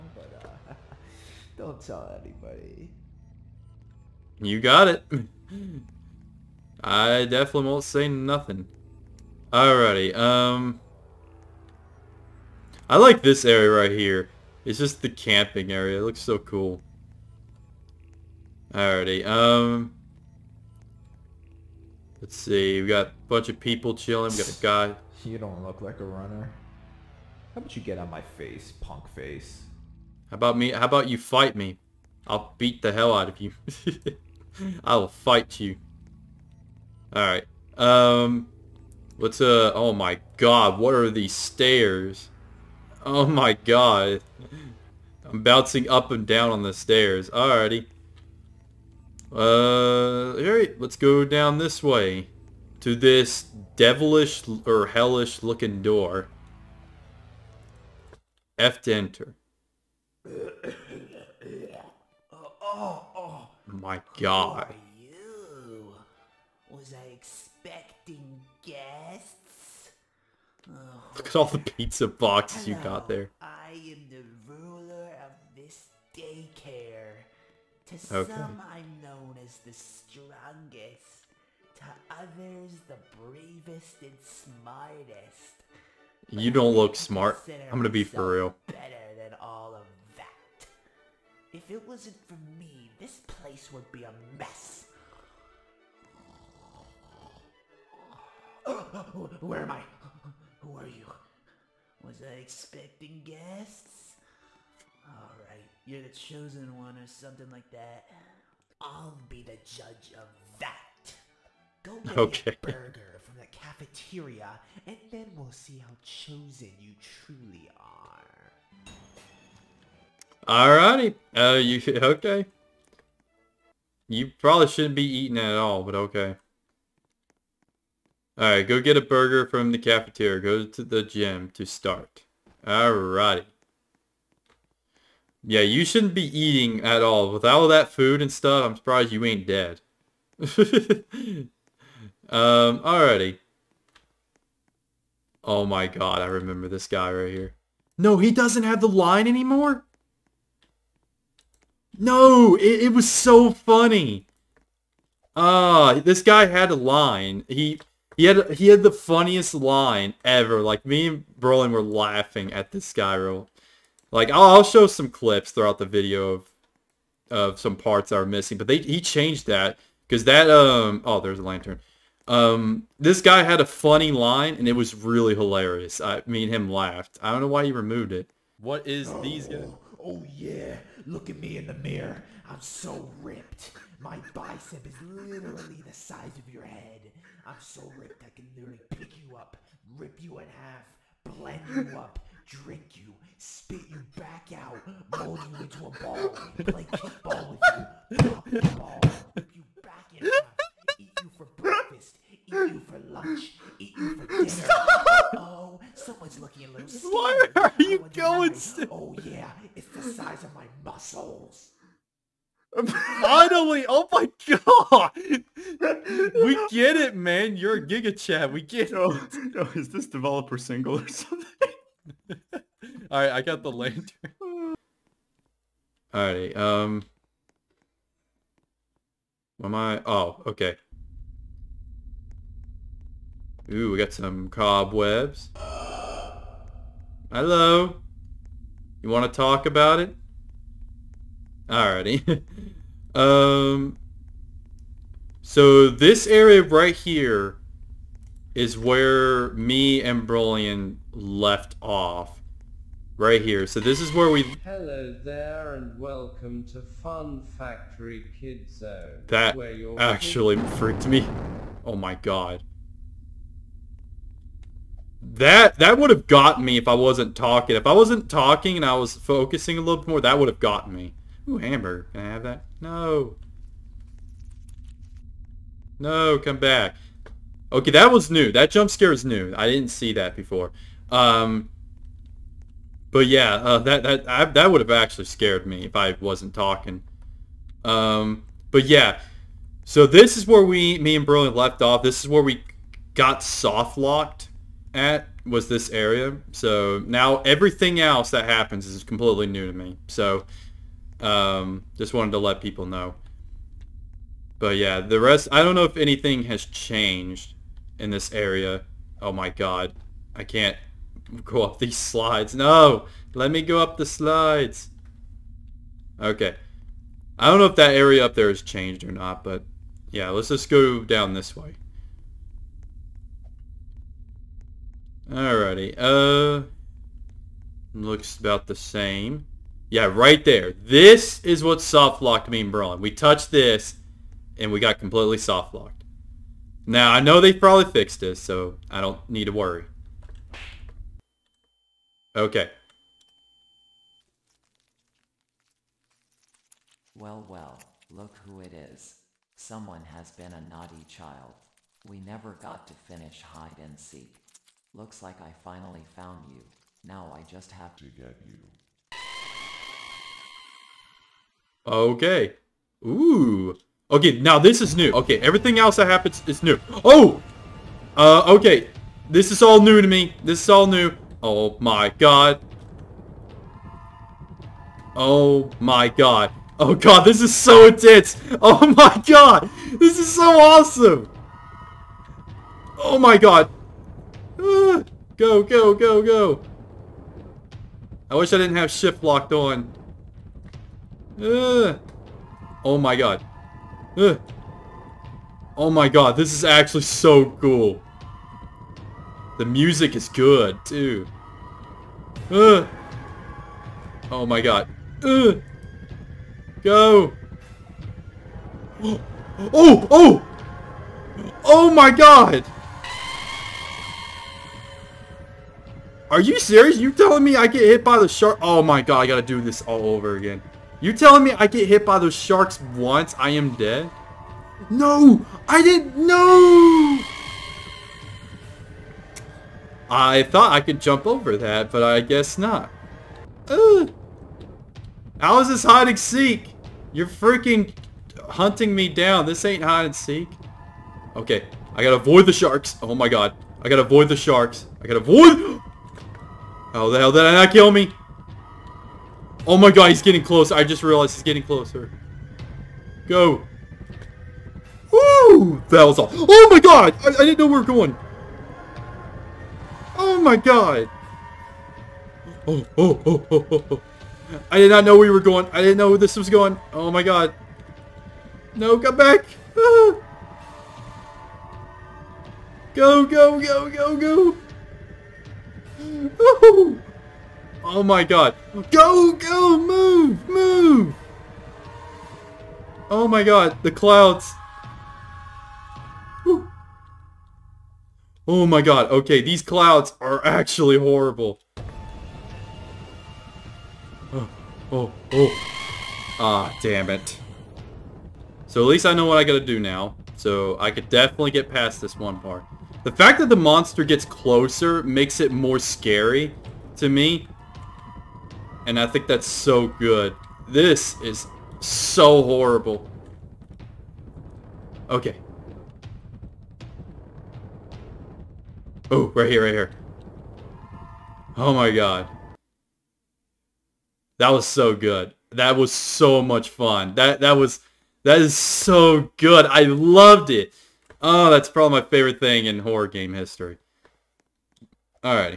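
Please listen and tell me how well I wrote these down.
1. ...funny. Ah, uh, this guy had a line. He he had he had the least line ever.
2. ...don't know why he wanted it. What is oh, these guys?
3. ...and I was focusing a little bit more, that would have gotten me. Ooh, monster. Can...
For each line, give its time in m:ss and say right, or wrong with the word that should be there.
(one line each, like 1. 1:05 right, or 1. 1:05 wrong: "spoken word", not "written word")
1. 2:33 wrong: "funniest", not "least"
2. 2:57 wrong: "removed", not "wanted"
3. 4:28 wrong: "hamburger", not "monster".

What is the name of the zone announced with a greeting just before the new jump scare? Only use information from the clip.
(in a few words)
Fun Factory Kid Zone.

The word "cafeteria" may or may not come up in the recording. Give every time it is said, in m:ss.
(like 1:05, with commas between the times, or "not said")
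1:53, 2:09.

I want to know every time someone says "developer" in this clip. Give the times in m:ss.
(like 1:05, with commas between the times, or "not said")
3:40.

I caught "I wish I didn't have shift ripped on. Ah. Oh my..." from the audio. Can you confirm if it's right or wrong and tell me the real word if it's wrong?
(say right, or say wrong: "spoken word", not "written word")
wrong: "locked", not "ripped".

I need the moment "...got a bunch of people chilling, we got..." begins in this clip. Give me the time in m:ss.
0:22.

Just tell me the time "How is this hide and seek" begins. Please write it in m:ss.
7:15.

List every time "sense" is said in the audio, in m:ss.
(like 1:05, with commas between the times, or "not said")
not said.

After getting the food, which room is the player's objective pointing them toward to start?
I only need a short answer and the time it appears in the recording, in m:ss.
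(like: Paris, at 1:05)
the gym, at 2:10.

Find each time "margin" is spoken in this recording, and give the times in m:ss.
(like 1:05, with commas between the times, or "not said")
not said.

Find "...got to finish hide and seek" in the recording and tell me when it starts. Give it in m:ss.
5:52.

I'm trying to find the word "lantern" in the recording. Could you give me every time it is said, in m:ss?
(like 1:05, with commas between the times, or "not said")
2:51, 3:43.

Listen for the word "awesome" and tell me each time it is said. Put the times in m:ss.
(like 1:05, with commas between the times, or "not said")
6:20.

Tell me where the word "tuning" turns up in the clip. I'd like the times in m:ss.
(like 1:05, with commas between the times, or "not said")
not said.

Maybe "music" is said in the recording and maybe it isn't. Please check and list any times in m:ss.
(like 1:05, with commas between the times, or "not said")
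6:39.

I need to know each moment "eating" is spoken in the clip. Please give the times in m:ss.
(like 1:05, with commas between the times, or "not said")
2:05, 2:16.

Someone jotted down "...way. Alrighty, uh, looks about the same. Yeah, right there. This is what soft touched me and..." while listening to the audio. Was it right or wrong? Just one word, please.
wrong.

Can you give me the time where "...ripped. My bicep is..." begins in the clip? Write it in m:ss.
3:03.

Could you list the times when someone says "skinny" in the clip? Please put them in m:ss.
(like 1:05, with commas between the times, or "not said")
3:26.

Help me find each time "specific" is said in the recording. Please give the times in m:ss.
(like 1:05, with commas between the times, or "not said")
not said.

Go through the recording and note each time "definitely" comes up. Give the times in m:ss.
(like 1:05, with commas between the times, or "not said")
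0:07, 8:21.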